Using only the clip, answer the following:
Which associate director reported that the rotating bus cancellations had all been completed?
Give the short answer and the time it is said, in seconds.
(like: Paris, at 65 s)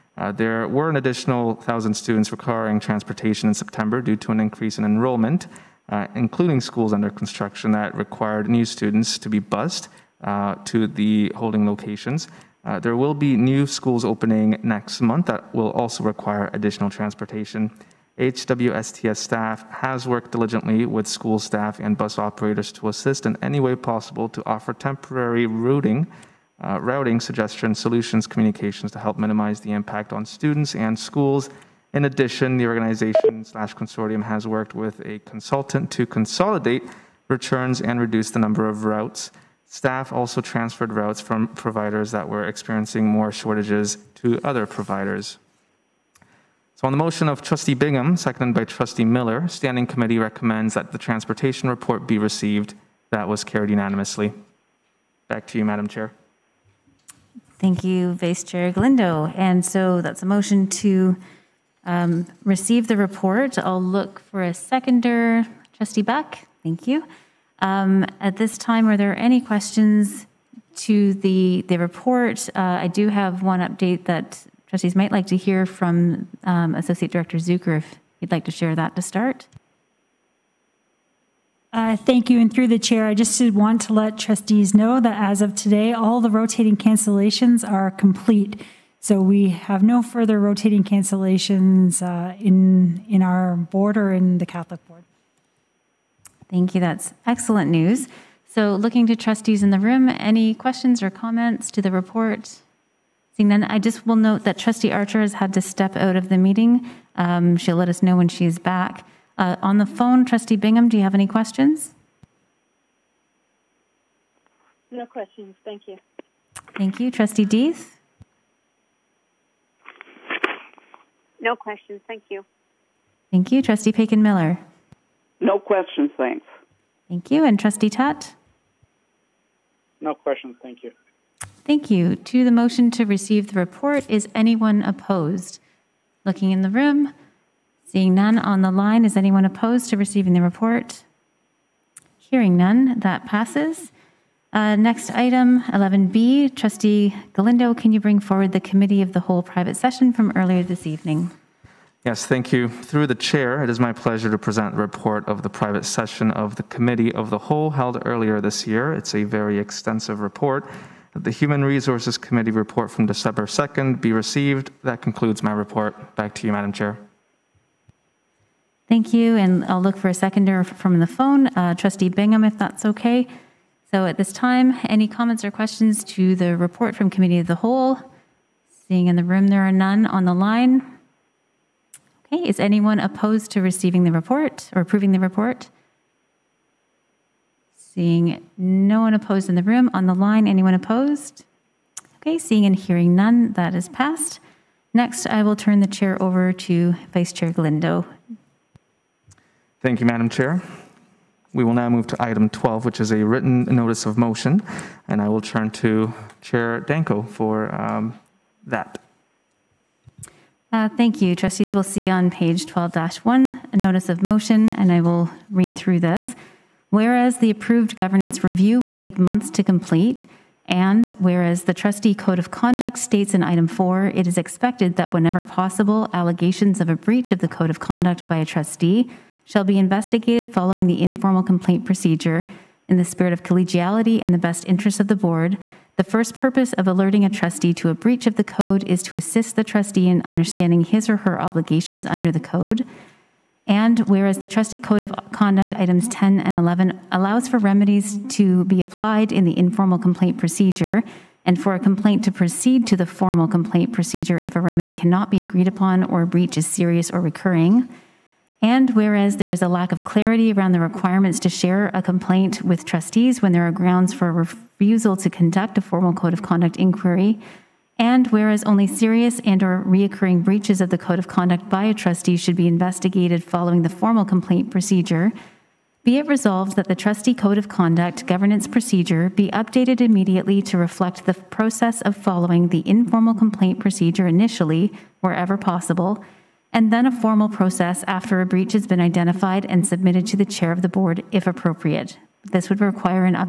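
Zucker, at 77 s.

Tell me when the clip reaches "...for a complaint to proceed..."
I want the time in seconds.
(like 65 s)
251 s.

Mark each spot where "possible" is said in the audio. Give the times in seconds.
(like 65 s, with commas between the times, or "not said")
23 s, 225 s, 285 s.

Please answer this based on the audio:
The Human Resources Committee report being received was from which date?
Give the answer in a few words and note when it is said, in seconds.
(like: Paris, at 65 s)
December 2, at 163 s.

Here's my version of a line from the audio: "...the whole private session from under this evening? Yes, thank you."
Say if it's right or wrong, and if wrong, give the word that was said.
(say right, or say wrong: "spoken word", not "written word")
wrong: "earlier", not "under".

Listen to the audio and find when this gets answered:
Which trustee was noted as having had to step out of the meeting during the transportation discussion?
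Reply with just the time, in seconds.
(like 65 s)
104 s.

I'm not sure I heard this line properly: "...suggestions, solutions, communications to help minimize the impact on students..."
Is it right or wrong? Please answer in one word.
right.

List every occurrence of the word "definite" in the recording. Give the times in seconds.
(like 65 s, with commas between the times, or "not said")
not said.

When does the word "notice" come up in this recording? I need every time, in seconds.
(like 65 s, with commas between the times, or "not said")
203 s, 213 s.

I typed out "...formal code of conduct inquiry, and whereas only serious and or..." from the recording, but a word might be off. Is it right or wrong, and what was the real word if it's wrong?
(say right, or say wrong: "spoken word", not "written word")
right.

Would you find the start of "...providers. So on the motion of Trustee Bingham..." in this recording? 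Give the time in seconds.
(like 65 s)
44 s.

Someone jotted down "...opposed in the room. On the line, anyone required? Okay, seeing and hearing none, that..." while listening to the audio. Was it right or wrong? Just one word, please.
wrong.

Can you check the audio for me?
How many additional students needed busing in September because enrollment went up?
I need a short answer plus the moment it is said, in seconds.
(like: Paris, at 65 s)
1,000, at 1 s.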